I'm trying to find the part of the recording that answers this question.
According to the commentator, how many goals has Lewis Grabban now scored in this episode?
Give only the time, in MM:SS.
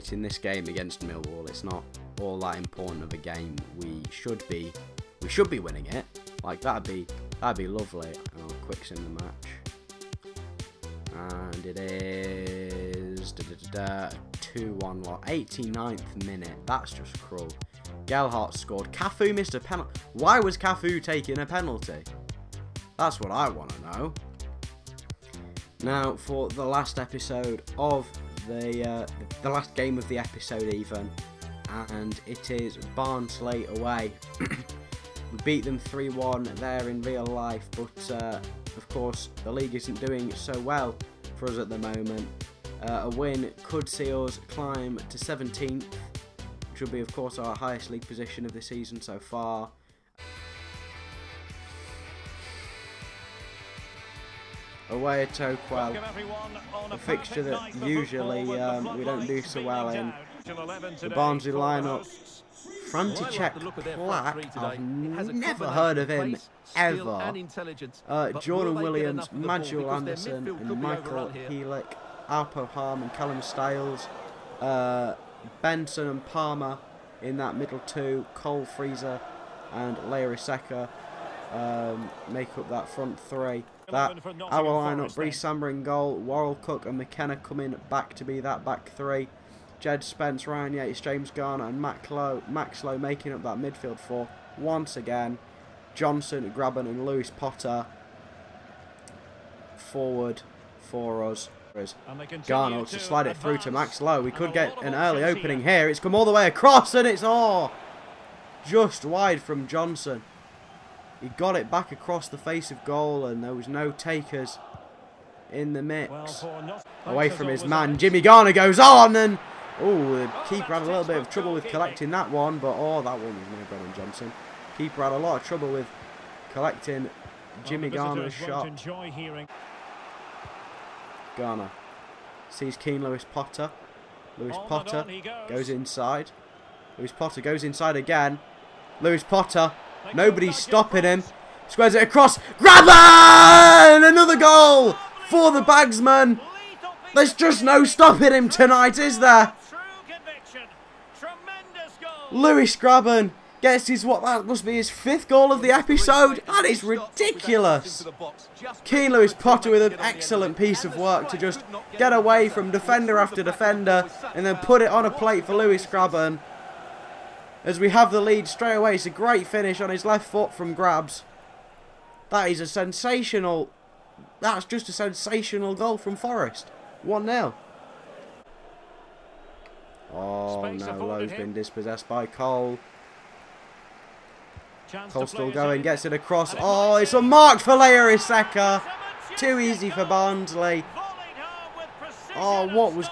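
02:34.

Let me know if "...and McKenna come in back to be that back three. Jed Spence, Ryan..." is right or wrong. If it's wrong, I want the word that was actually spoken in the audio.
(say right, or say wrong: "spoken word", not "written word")
right.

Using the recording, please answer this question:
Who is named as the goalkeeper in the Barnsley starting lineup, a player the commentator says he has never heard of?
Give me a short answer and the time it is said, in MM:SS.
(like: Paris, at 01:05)
František Plach, at 01:02.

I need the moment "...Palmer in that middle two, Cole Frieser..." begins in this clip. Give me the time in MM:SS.
01:16.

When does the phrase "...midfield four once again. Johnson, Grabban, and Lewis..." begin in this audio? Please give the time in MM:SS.
01:33.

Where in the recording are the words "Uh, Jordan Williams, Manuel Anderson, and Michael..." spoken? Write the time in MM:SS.
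01:08.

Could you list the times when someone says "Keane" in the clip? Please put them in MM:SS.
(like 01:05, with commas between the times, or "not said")
02:12, 02:38.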